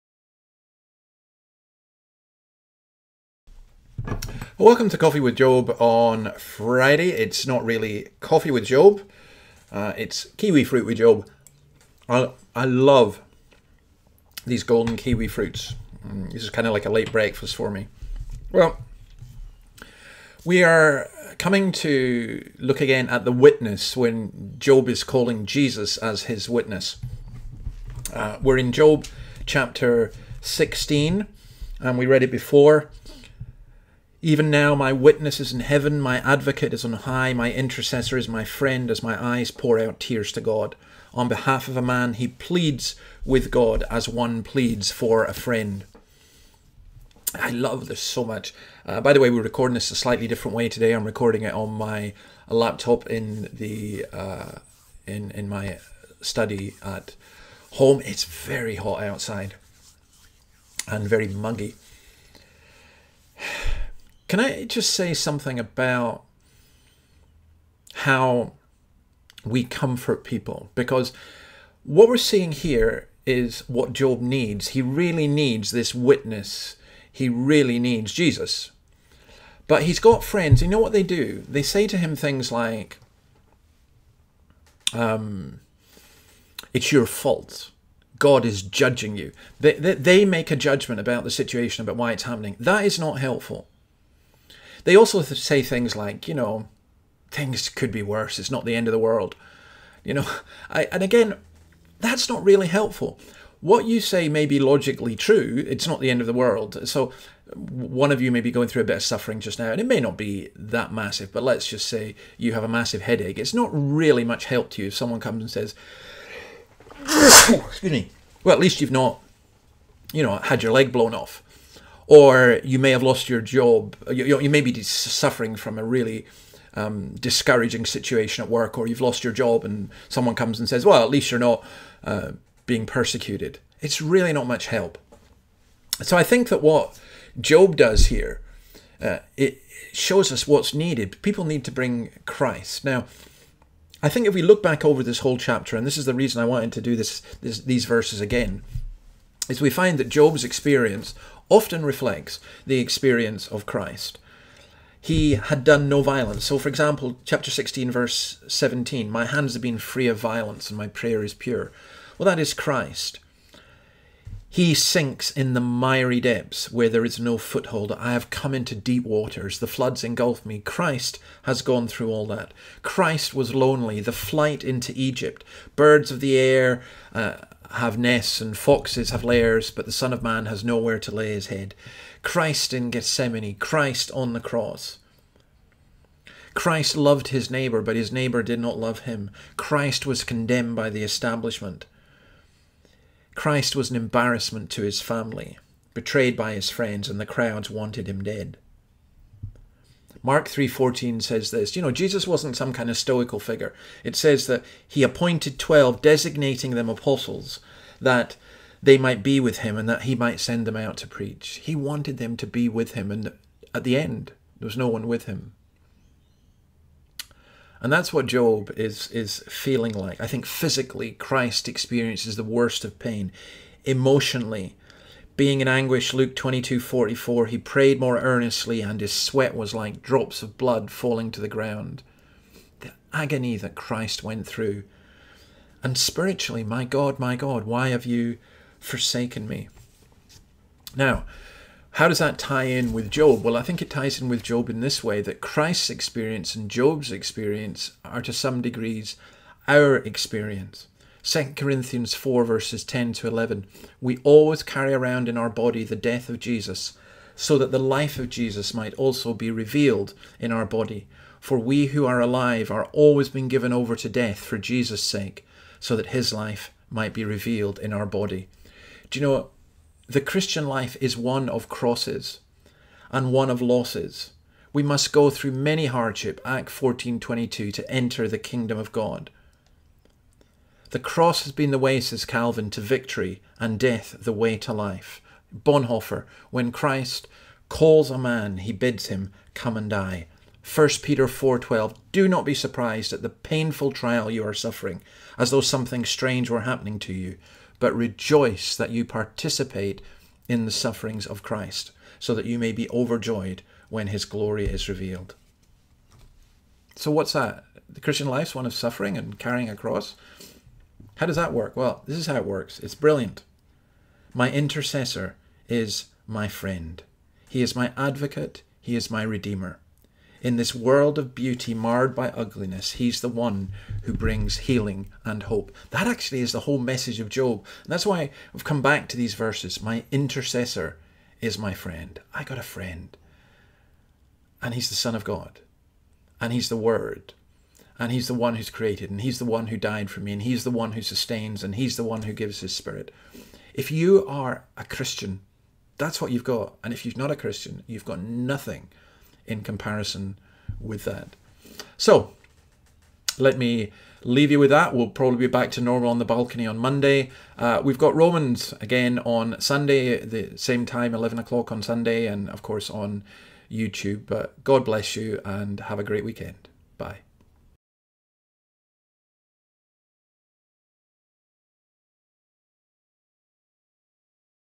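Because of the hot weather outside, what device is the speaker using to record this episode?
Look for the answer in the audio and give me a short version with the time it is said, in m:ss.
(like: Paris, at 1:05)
Laptop, at 0:52.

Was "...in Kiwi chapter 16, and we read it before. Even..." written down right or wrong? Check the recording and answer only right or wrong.
wrong.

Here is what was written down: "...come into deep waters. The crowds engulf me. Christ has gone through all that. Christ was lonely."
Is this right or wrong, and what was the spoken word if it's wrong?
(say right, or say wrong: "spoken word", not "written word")
wrong: "floods", not "crowds".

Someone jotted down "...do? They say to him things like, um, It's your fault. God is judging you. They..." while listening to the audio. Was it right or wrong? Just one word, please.
right.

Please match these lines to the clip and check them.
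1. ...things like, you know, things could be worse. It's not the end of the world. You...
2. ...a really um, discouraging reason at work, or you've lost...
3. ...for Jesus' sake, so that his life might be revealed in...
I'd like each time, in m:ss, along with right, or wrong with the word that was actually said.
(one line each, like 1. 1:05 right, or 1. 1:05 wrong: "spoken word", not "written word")
1. 1:35 right
2. 2:05 wrong: "situation", not "reason"
3. 4:24 right.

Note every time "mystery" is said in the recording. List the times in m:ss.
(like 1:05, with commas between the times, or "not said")
not said.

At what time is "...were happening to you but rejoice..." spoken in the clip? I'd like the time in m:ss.
4:56.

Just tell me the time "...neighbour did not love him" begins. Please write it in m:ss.
3:08.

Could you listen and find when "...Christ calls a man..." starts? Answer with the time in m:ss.
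4:46.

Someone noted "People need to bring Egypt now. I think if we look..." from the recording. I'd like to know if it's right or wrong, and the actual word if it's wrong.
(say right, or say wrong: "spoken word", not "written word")
wrong: "Christ", not "Egypt".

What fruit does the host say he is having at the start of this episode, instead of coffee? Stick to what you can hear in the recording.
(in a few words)
Golden kiwi fruits.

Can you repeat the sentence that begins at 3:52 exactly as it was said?
The agony that Christ went through.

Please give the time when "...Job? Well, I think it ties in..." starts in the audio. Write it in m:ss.
4:03.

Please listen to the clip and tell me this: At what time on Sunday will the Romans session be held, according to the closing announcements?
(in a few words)
11 o'clock.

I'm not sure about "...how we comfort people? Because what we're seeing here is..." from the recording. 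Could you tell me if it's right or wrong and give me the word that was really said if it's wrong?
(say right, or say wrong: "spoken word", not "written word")
right.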